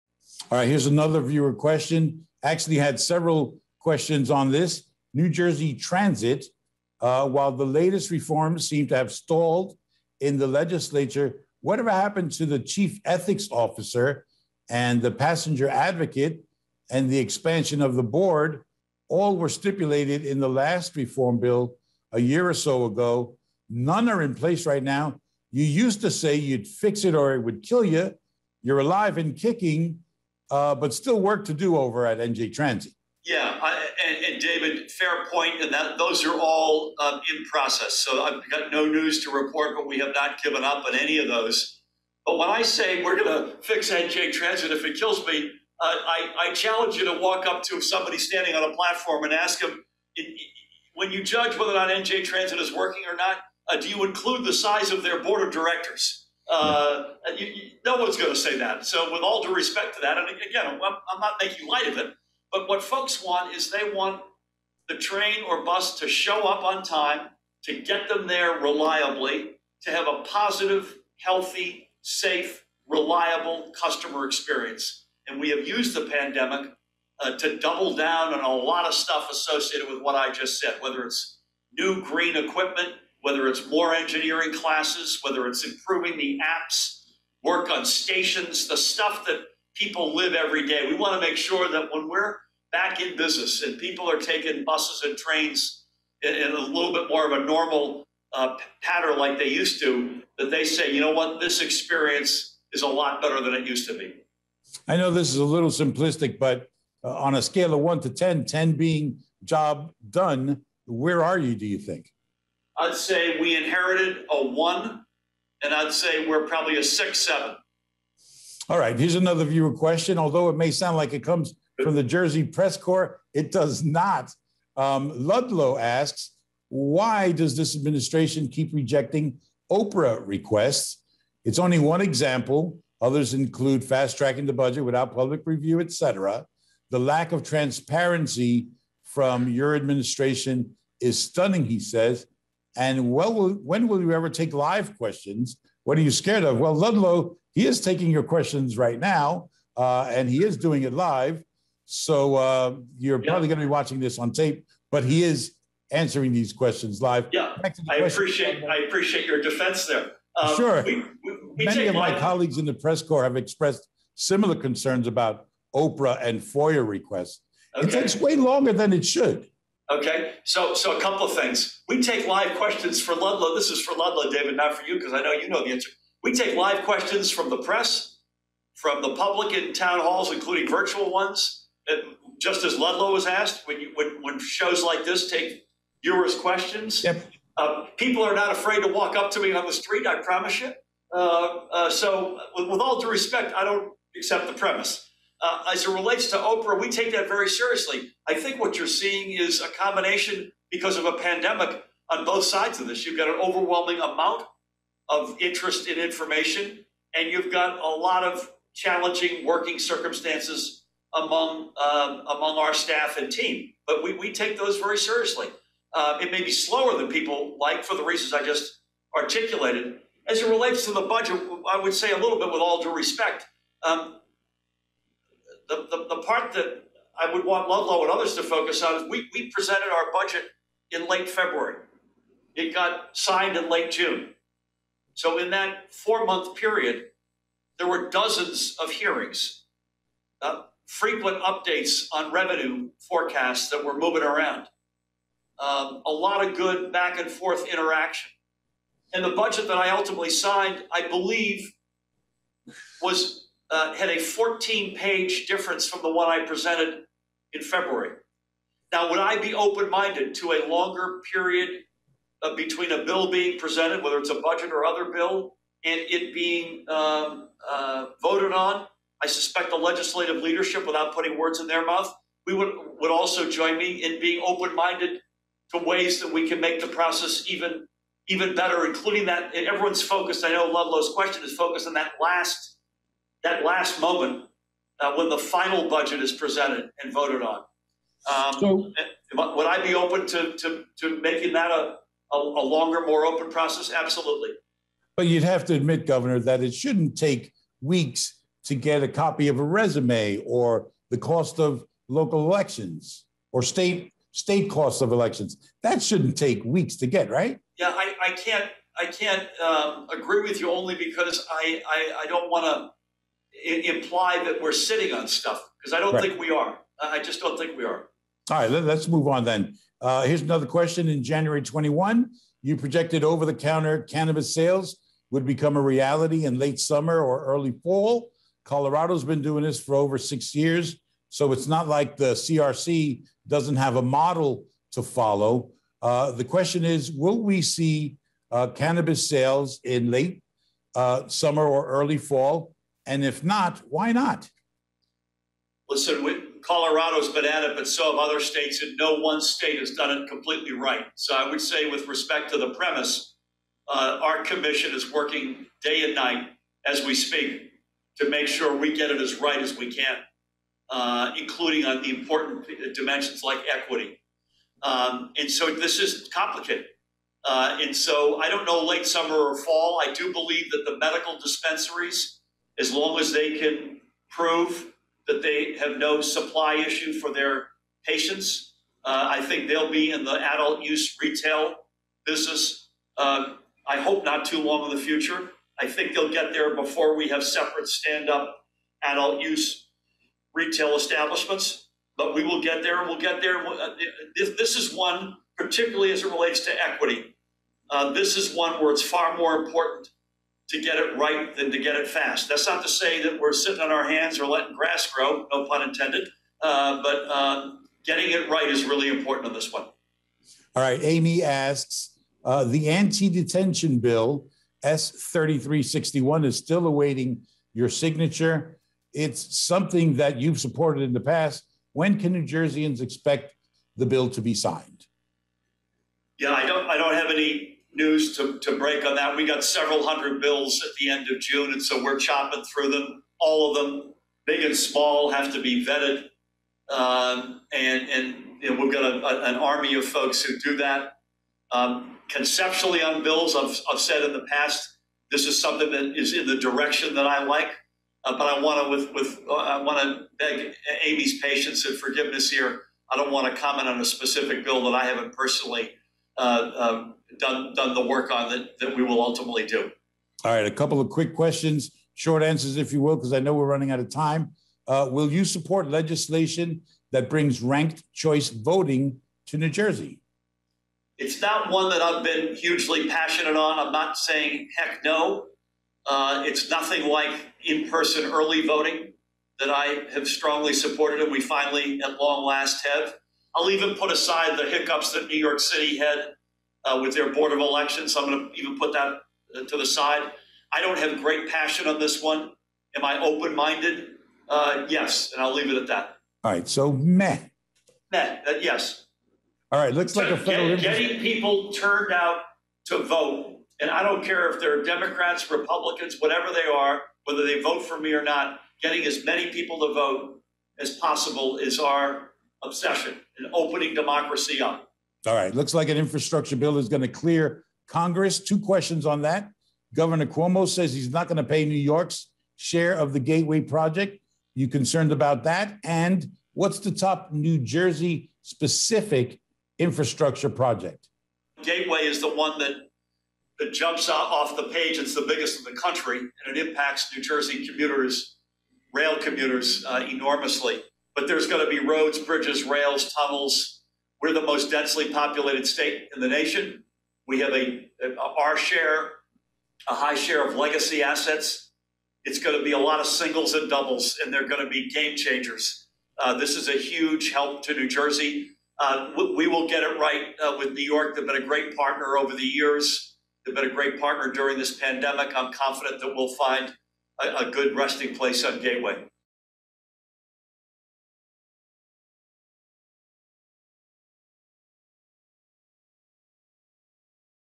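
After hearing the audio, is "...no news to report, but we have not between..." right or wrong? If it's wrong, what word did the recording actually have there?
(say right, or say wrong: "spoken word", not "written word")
wrong: "given", not "between".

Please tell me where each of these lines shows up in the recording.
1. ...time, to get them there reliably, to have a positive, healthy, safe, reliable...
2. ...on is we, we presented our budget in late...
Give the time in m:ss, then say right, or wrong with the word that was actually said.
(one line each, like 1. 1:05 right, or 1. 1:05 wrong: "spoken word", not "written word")
1. 1:06 right
2. 3:48 right.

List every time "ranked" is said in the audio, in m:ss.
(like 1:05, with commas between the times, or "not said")
7:47.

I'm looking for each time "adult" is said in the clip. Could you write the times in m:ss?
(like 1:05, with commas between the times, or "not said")
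6:20, 6:29.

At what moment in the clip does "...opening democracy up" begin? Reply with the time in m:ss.
8:33.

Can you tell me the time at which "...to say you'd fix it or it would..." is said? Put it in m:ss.
0:26.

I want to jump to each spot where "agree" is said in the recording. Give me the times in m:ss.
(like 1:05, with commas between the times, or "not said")
5:10.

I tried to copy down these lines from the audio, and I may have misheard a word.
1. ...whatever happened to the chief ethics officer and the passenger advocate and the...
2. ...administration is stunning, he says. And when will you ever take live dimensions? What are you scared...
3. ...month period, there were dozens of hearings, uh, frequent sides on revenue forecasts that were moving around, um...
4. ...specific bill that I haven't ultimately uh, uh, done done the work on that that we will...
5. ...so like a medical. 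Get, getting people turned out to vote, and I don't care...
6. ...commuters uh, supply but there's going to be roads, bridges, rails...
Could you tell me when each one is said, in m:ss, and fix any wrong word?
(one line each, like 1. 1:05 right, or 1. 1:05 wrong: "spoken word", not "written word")
1. 0:11 right
2. 2:19 wrong: "questions", not "dimensions"
3. 3:56 wrong: "updates", not "sides"
4. 7:34 wrong: "personally", not "ultimately"
5. 8:20 wrong: "federal", not "medical"
6. 8:59 wrong: "enormously", not "supply".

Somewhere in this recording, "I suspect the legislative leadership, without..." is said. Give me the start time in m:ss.
4:29.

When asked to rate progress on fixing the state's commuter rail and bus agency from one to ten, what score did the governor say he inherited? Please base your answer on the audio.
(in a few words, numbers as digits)
1.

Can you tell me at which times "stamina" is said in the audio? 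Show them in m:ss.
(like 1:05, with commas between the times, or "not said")
not said.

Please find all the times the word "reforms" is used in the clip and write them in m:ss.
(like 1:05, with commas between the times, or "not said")
0:08, 0:20.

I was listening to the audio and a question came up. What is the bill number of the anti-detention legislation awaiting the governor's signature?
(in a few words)
S 3361.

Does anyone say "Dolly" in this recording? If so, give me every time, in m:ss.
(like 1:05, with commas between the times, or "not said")
not said.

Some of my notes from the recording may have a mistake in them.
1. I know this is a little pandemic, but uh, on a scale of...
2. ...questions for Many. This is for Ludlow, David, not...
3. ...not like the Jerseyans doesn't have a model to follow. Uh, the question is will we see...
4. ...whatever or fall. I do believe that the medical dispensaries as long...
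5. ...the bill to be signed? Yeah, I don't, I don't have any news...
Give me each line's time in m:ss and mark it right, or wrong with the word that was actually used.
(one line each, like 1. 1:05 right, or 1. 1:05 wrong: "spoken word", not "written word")
1. 1:44 wrong: "simplistic", not "pandemic"
2. 2:52 wrong: "Ludlow", not "Many"
3. 5:31 wrong: "CRC", not "Jerseyans"
4. 6:09 wrong: "summer", not "whatever"
5. 7:03 right.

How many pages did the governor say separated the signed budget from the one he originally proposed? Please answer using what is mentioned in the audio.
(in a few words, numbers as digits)
14.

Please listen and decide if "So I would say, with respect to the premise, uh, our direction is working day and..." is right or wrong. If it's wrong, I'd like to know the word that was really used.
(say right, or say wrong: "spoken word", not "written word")
wrong: "commission", not "direction".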